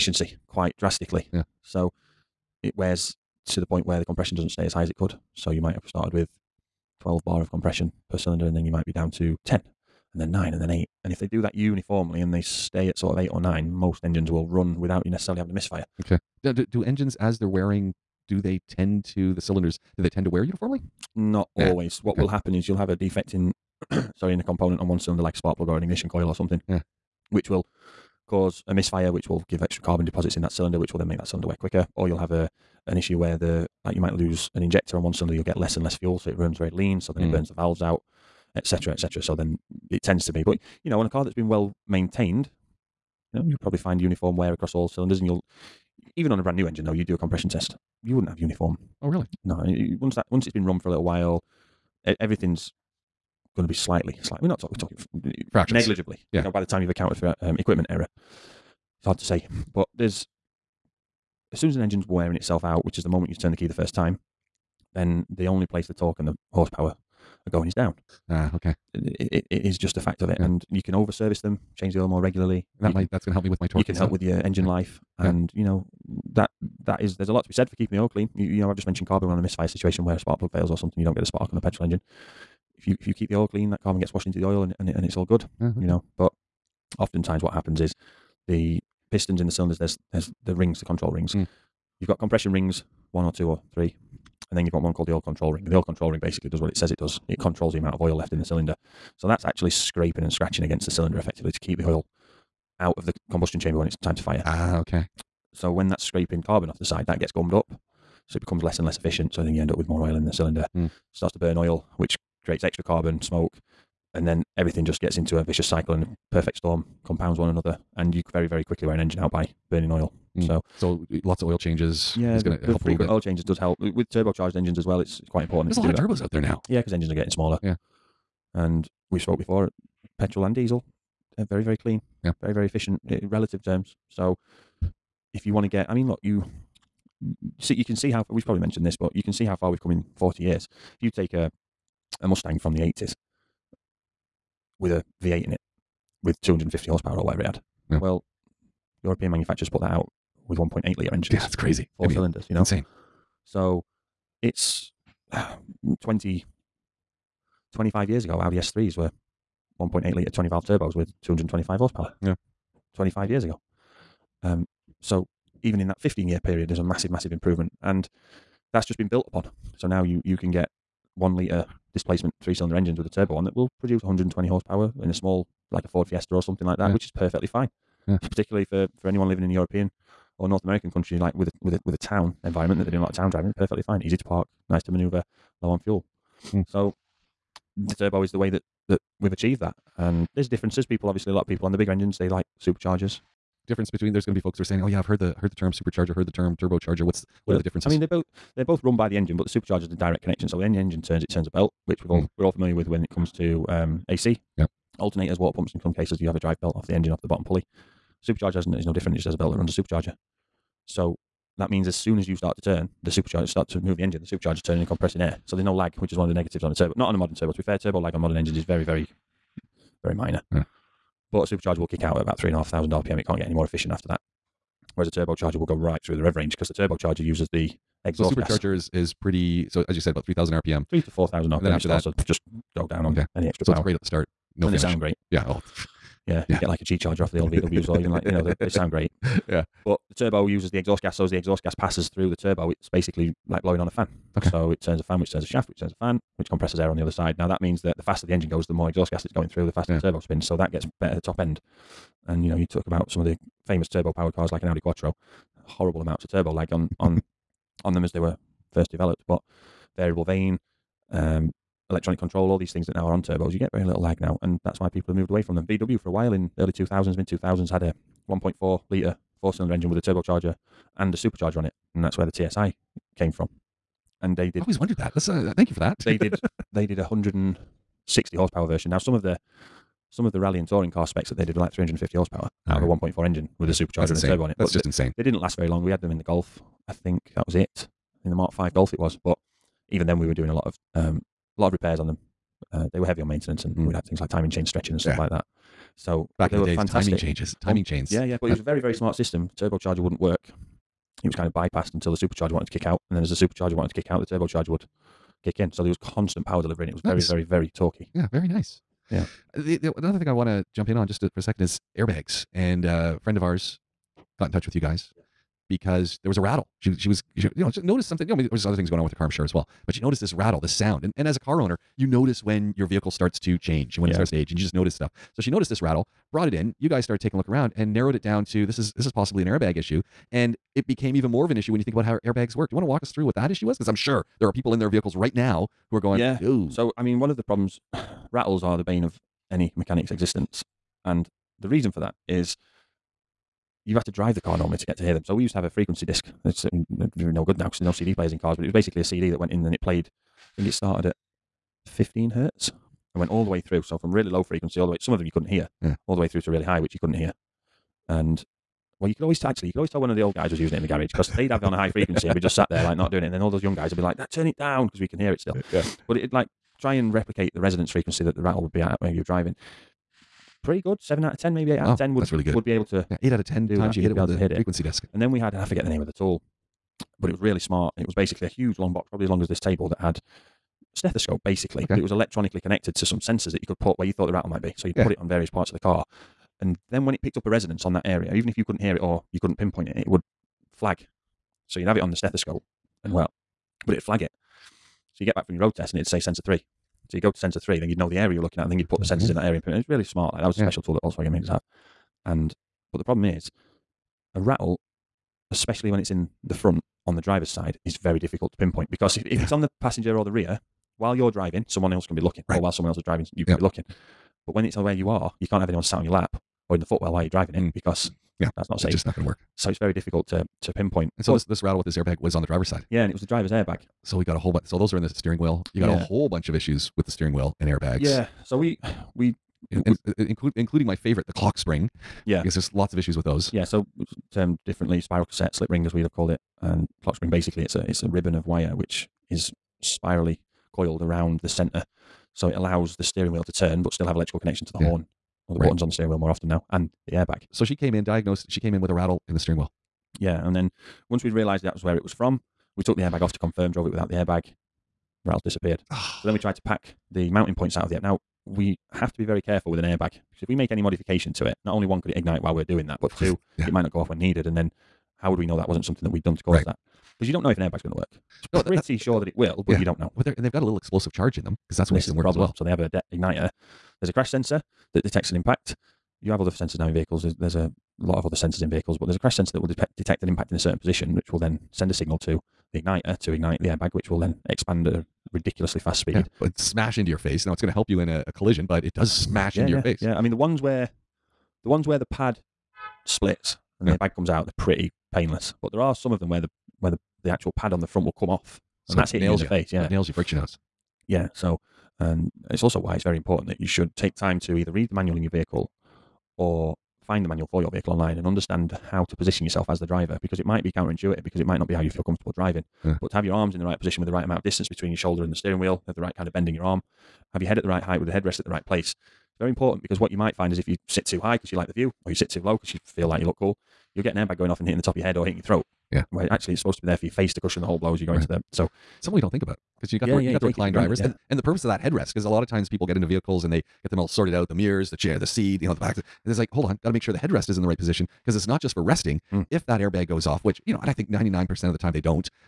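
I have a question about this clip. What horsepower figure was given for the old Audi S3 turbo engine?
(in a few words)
225.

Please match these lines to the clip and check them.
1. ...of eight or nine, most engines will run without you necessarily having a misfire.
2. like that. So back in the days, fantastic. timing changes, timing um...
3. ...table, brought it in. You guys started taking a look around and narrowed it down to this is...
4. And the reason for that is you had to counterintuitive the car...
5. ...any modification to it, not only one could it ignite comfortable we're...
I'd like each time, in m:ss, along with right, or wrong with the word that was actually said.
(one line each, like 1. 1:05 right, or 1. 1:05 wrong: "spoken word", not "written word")
1. 0:13 right
2. 4:55 right
3. 5:25 wrong: "rattle", not "table"
4. 5:41 wrong: "drive", not "counterintuitive"
5. 7:40 wrong: "while", not "comfortable".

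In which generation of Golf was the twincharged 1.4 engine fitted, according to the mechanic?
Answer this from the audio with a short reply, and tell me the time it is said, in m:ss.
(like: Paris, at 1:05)
Mark Five, at 4:48.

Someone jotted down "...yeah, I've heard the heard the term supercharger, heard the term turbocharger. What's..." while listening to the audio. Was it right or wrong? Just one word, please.
right.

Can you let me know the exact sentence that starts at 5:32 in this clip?
Do you want to walk us through what that issue was?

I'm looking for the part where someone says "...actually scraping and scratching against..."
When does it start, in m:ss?
1:39.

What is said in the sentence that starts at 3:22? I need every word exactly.
we're all familiar with when it comes to um, AC.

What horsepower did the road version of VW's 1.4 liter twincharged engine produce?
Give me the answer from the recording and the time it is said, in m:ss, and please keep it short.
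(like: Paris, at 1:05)
160, at 4:36.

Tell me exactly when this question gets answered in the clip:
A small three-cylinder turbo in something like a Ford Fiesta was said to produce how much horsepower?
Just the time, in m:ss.
2:54.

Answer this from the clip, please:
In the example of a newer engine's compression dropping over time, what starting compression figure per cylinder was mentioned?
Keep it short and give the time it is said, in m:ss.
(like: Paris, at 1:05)
12 bar, at 0:06.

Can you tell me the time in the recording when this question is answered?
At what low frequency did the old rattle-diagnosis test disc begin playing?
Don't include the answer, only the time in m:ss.
5:51.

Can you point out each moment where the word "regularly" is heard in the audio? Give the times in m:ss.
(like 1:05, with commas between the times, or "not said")
1:12.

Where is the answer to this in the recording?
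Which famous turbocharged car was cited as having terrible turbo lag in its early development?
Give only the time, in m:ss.
4:14.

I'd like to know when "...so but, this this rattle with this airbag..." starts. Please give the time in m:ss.
7:01.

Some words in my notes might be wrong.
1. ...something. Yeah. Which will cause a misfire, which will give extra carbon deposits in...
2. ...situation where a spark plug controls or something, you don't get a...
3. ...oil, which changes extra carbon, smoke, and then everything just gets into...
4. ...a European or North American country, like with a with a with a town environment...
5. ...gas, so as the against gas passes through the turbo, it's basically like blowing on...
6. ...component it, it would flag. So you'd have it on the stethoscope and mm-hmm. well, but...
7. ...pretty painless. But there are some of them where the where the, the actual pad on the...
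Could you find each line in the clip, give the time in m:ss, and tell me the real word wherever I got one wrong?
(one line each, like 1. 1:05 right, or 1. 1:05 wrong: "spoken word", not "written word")
1. 0:26 right
2. 1:19 wrong: "fails", not "controls"
3. 1:51 wrong: "creates", not "changes"
4. 2:59 right
5. 4:01 wrong: "exhaust", not "against"
6. 6:29 wrong: "pinpoint", not "component"
7. 8:14 right.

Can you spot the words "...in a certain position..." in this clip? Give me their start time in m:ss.
8:00.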